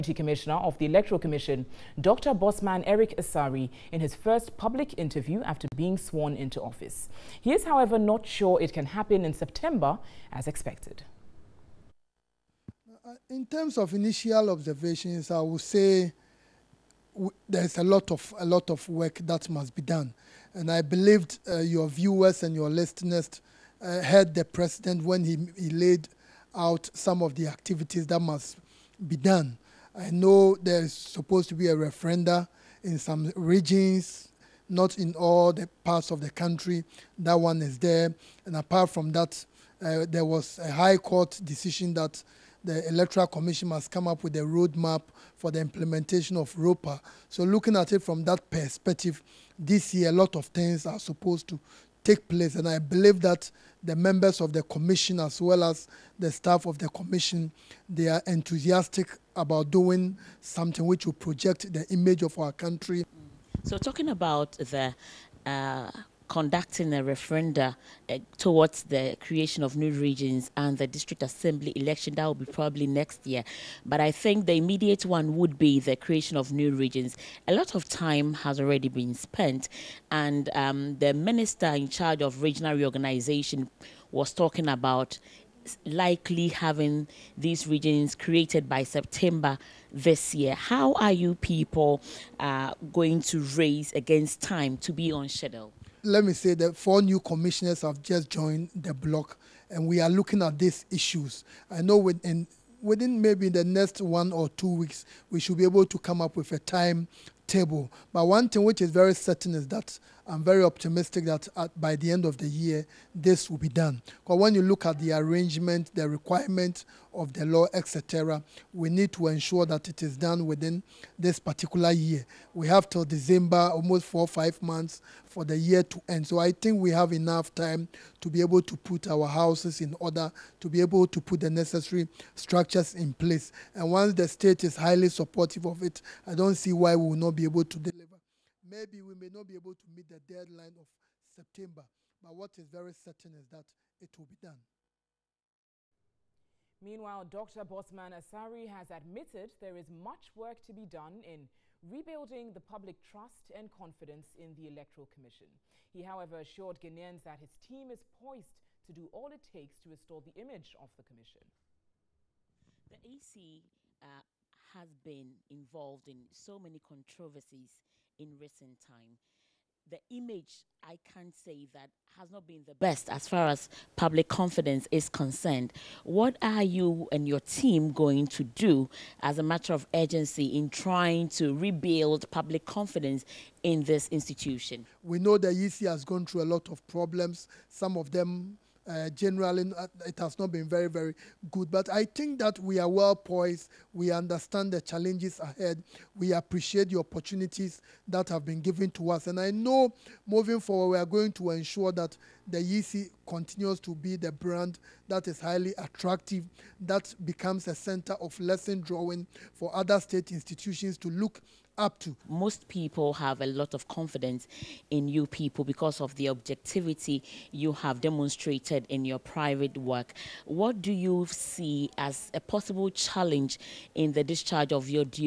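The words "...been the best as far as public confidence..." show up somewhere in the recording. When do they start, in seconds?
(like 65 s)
172 s.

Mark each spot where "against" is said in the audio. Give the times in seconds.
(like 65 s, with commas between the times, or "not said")
93 s.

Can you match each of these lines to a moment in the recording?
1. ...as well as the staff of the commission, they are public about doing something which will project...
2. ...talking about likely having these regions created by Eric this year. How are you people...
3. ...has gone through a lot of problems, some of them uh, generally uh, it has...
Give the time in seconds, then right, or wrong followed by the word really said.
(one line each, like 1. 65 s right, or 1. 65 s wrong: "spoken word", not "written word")
1. 55 s wrong: "enthusiastic", not "public"
2. 84 s wrong: "September", not "Eric"
3. 185 s right.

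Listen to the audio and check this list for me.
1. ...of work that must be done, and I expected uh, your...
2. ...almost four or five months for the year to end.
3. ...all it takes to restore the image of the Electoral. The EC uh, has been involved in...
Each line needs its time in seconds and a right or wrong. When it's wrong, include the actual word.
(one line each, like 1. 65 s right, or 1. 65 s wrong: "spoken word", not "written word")
1. 18 s wrong: "believed", not "expected"
2. 123 s right
3. 159 s wrong: "Commission", not "Electoral".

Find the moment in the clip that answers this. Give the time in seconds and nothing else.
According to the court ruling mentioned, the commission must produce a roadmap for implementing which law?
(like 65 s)
46 s.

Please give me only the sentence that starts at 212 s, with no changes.
Most people have a lot of confidence in you people because of the objectivity you have demonstrated in your private work.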